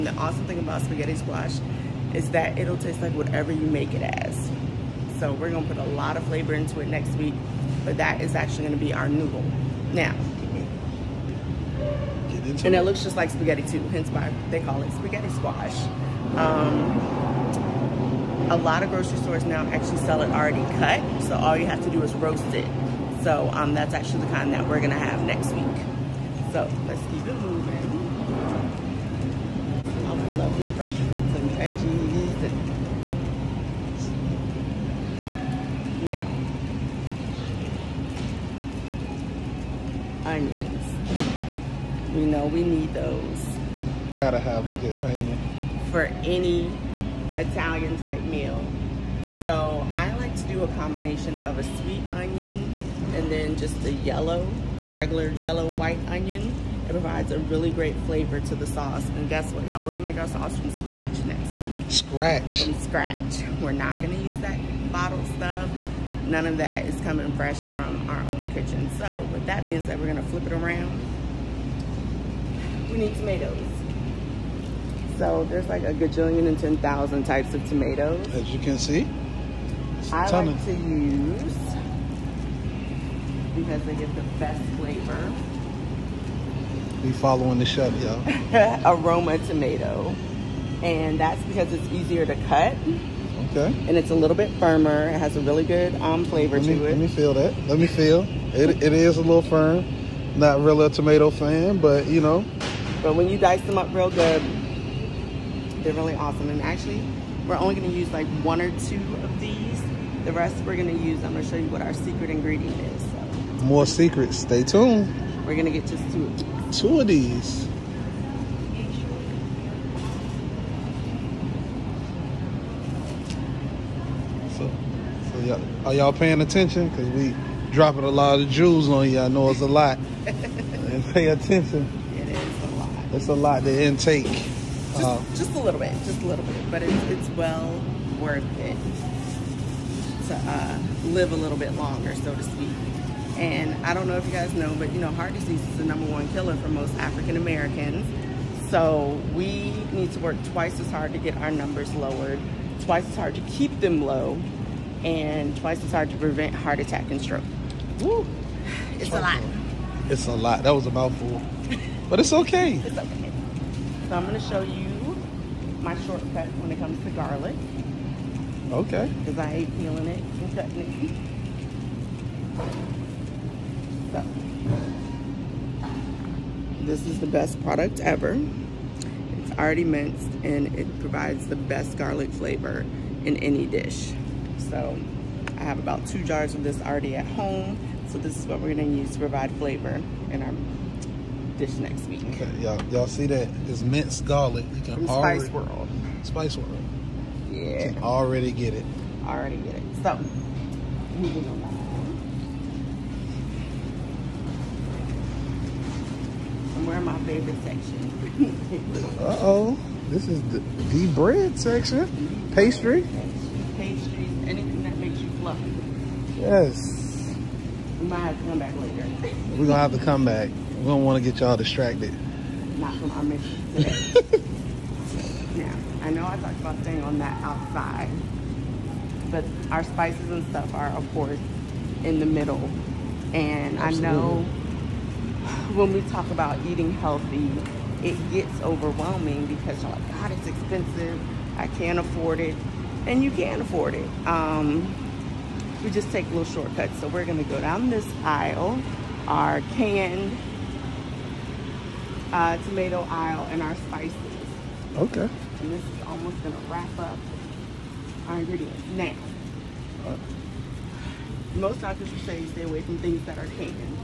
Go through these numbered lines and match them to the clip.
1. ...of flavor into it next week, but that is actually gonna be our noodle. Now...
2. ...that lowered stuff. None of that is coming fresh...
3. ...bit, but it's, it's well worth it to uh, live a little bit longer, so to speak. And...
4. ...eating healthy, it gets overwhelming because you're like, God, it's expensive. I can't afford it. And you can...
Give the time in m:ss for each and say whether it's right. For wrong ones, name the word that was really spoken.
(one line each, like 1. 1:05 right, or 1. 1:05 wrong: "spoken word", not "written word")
1. 0:06 right
2. 1:04 wrong: "bottled", not "lowered"
3. 2:16 right
4. 3:56 right.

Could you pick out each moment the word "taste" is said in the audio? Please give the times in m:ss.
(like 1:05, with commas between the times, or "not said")
0:02.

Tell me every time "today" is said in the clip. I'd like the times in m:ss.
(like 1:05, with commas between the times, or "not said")
3:43.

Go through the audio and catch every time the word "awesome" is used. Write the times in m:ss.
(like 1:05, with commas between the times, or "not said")
0:00, 1:46.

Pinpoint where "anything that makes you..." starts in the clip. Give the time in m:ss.
3:34.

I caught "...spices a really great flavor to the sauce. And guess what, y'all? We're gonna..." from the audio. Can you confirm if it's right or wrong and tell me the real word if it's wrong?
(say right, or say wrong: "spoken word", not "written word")
wrong: "provides", not "spices".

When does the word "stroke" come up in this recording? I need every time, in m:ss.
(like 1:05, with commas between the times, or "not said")
2:37.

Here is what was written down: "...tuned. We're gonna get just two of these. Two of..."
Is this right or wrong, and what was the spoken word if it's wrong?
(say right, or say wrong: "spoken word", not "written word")
right.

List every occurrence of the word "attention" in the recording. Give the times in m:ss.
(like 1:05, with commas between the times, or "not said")
2:06, 2:11.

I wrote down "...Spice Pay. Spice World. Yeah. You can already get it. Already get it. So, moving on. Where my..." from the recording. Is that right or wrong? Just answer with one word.
wrong.